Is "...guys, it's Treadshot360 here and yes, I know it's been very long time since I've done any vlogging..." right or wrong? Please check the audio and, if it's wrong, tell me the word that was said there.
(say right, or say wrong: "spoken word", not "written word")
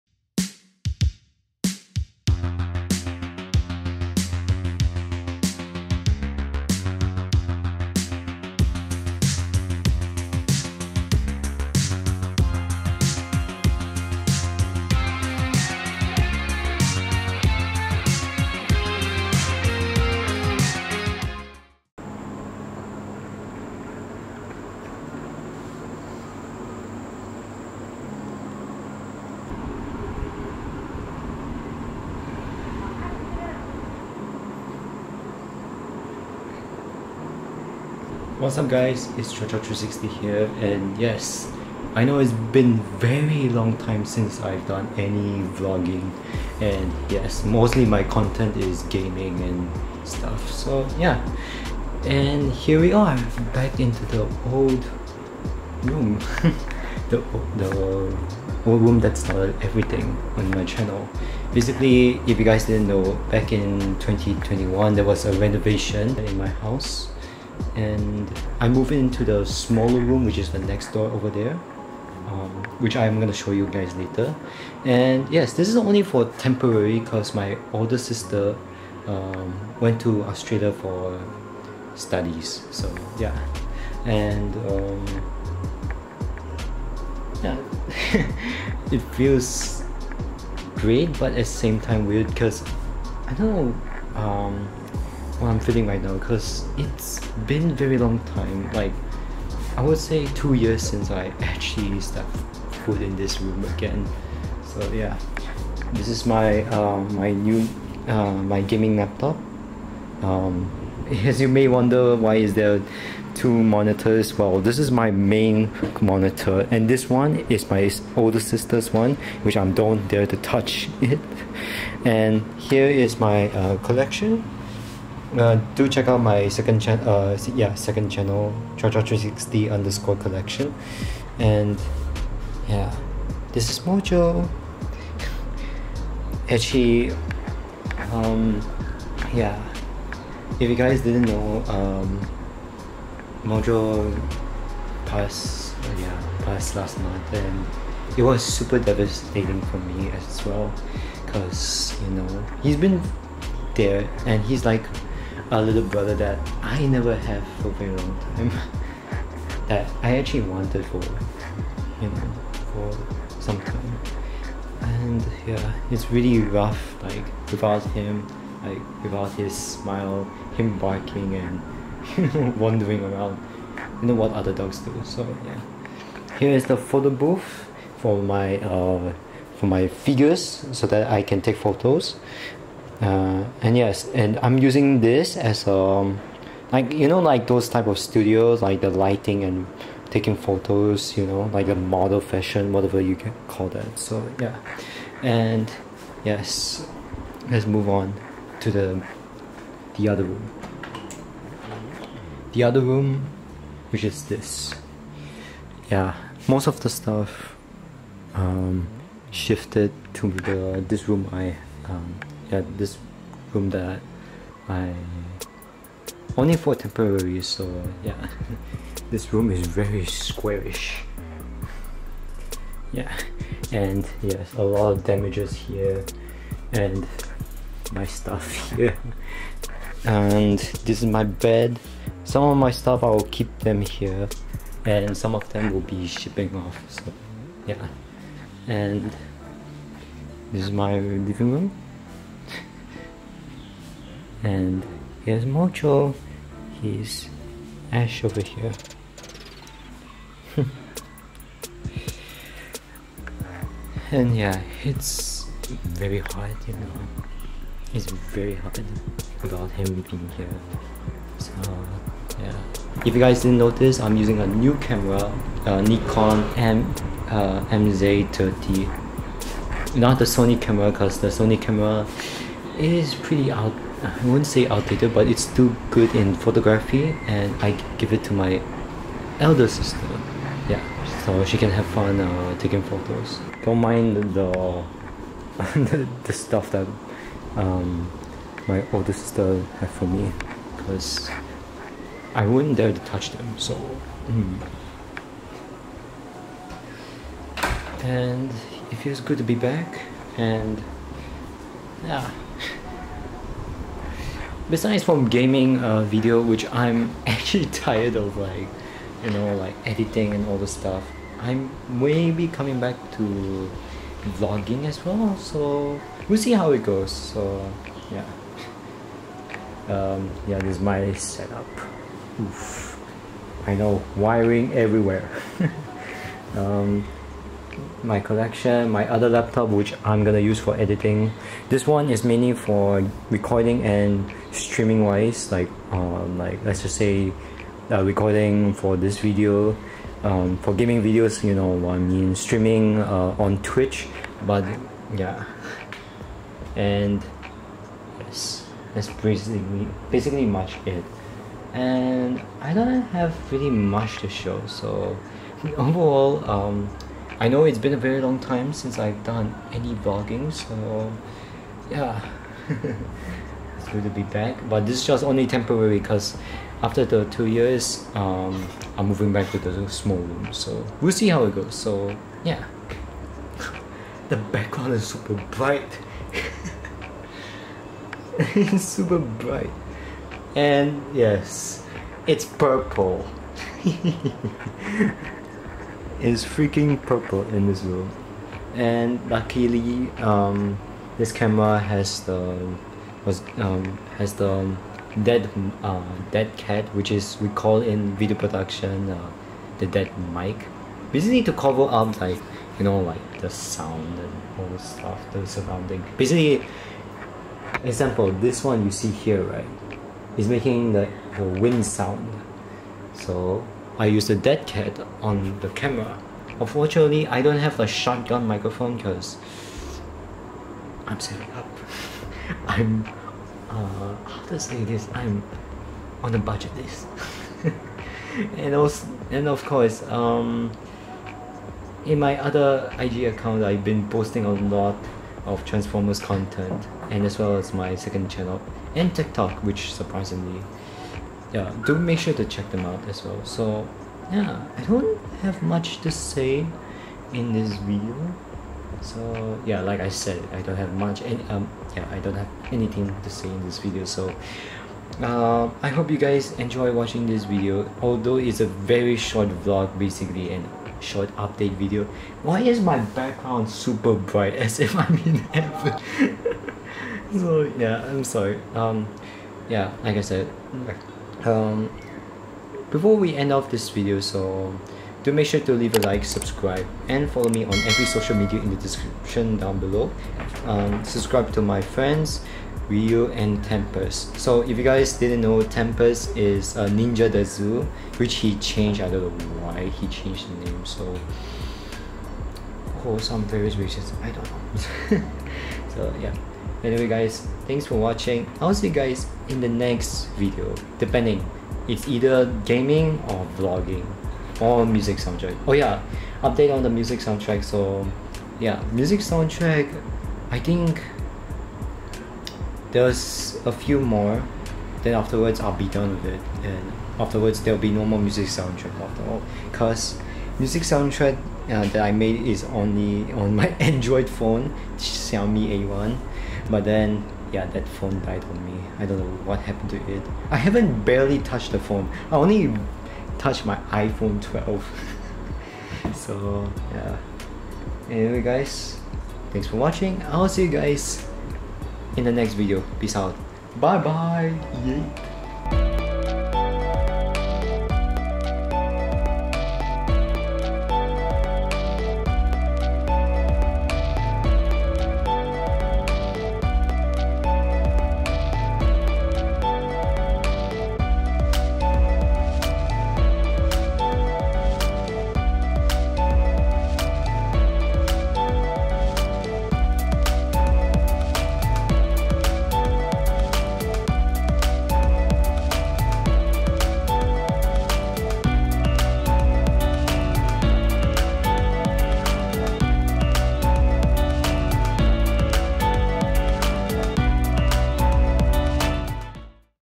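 right.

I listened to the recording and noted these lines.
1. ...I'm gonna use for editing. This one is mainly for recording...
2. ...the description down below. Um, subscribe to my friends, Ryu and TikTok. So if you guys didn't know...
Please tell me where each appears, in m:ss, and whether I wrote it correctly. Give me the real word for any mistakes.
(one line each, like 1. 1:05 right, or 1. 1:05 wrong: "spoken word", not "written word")
1. 5:30 right
2. 7:58 wrong: "Tempest", not "TikTok".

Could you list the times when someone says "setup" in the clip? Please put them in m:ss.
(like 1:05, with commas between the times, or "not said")
5:21.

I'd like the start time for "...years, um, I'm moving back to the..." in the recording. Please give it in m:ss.
6:07.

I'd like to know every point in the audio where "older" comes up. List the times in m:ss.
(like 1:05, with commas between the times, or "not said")
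1:17, 1:58, 4:48.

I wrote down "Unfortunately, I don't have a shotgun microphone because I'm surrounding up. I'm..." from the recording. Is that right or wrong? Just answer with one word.
wrong.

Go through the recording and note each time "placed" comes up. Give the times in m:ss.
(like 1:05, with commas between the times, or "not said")
not said.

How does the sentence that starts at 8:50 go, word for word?
I haven't barely touched the phone.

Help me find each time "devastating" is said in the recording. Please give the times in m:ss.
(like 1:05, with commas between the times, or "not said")
2:28.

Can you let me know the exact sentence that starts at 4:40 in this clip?
Yeah, so she can have fun uh, taking photos.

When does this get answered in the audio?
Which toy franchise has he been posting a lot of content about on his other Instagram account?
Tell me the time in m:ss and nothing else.
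7:15.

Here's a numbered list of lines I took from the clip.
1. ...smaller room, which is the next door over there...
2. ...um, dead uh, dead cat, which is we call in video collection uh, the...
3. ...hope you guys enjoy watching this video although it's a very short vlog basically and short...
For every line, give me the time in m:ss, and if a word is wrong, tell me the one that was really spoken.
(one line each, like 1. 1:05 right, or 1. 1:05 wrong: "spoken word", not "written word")
1. 1:09 right
2. 6:34 wrong: "production", not "collection"
3. 7:35 right.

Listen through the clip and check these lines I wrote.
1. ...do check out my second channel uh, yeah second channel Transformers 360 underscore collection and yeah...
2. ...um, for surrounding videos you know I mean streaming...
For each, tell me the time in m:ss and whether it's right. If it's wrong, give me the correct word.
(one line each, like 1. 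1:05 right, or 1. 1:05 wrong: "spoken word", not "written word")
1. 2:05 wrong: "Treadshot", not "Transformers"
2. 5:40 wrong: "gaming", not "surrounding".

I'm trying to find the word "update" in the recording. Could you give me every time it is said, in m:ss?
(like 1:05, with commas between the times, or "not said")
7:41, 8:26.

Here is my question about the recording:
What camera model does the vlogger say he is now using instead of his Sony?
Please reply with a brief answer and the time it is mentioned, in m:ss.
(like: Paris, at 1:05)
Nikon MZ30, at 4:25.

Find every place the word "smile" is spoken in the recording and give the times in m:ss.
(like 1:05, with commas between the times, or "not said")
2:49.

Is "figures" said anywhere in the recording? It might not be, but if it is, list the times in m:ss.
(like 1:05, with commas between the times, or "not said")
2:59.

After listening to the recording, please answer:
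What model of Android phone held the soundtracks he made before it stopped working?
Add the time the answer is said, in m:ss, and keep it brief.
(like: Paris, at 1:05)
Xiaomi A1, at 8:44.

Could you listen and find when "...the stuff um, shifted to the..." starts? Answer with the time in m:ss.
3:26.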